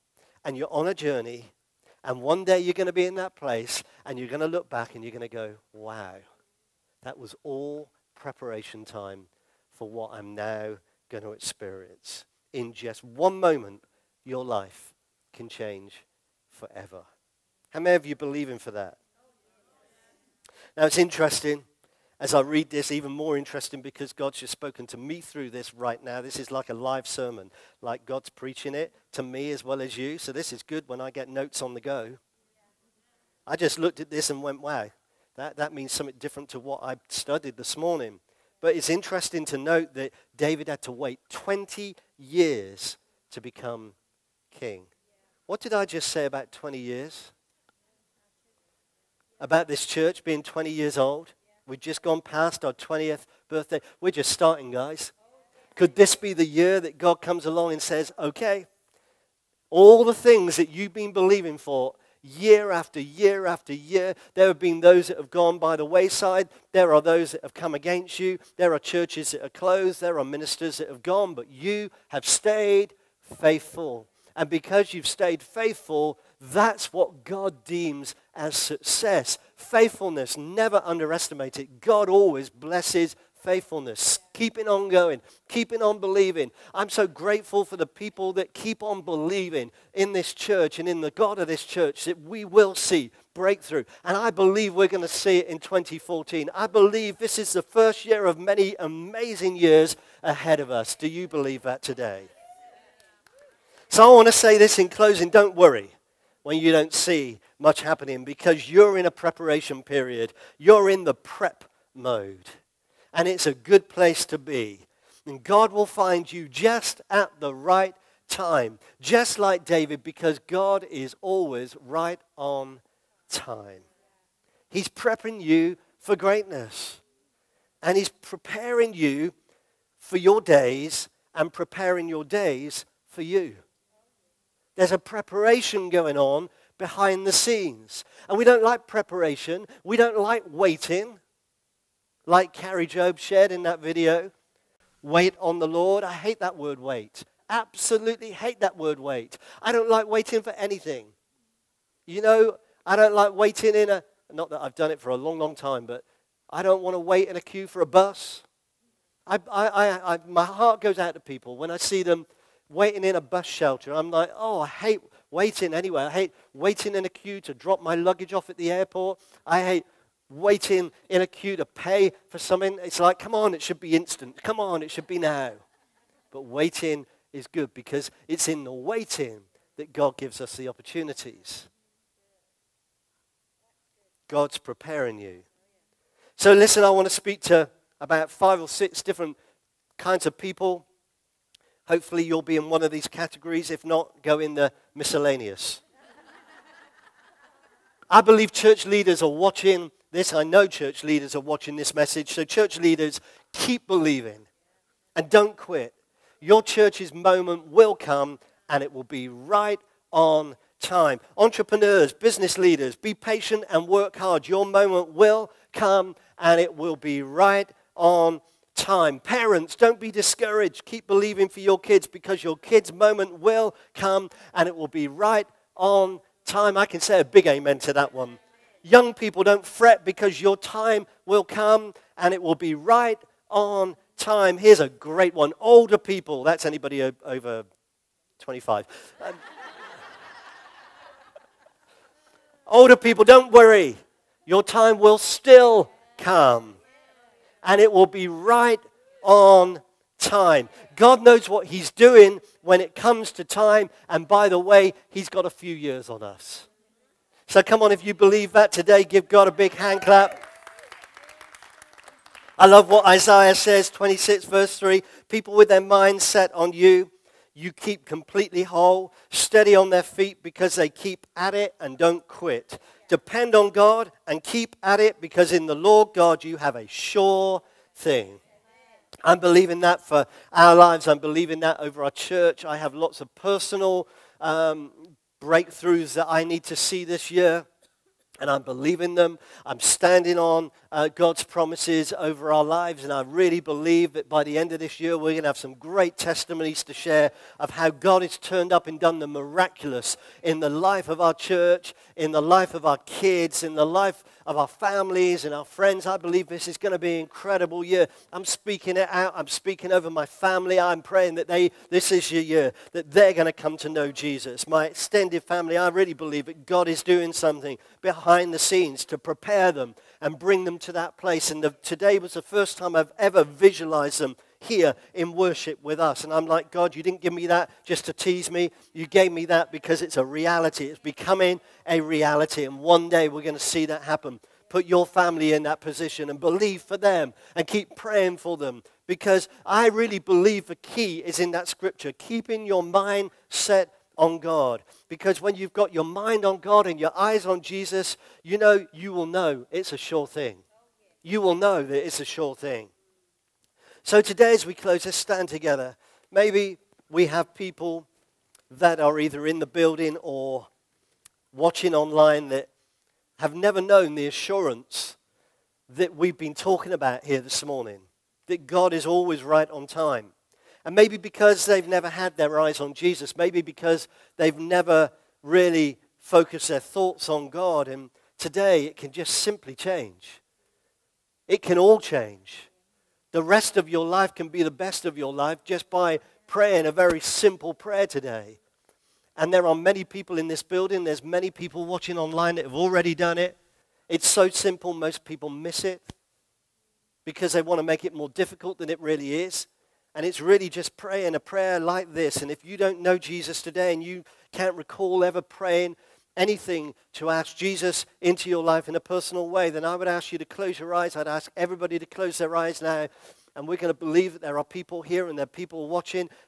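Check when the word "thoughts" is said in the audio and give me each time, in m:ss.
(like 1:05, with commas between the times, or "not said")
6:16.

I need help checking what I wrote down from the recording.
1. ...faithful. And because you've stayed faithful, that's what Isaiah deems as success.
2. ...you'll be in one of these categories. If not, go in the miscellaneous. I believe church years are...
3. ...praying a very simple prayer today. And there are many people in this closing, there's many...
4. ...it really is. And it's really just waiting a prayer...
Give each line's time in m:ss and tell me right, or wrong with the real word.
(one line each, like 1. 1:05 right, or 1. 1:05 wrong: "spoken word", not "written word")
1. 1:13 wrong: "God", not "Isaiah"
2. 3:12 wrong: "leaders", not "years"
3. 6:26 wrong: "building", not "closing"
4. 6:38 wrong: "praying", not "waiting".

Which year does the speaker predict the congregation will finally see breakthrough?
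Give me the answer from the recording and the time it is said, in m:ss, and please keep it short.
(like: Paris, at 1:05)
2014, at 1:35.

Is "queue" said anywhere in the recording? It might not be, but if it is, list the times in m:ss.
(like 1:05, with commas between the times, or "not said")
2:37, 2:47, 2:51.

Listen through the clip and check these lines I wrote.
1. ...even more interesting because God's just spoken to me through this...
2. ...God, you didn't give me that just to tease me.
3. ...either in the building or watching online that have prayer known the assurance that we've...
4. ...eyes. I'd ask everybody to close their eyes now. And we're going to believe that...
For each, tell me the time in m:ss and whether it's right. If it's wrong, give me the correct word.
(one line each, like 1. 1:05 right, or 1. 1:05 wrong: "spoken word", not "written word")
1. 0:22 right
2. 5:26 right
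3. 5:59 wrong: "never", not "prayer"
4. 6:50 right.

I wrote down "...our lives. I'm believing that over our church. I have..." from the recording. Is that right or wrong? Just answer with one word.
right.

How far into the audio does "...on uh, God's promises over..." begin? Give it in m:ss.
4:50.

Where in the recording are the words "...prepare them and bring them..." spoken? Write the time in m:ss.
5:19.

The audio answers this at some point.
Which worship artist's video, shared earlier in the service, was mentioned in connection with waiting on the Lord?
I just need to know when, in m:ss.
2:22.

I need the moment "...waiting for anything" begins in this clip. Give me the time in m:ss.
2:30.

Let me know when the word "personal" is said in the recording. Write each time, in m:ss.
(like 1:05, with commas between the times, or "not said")
4:43, 6:48.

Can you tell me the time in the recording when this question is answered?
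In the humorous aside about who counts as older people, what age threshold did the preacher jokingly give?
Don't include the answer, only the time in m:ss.
3:58.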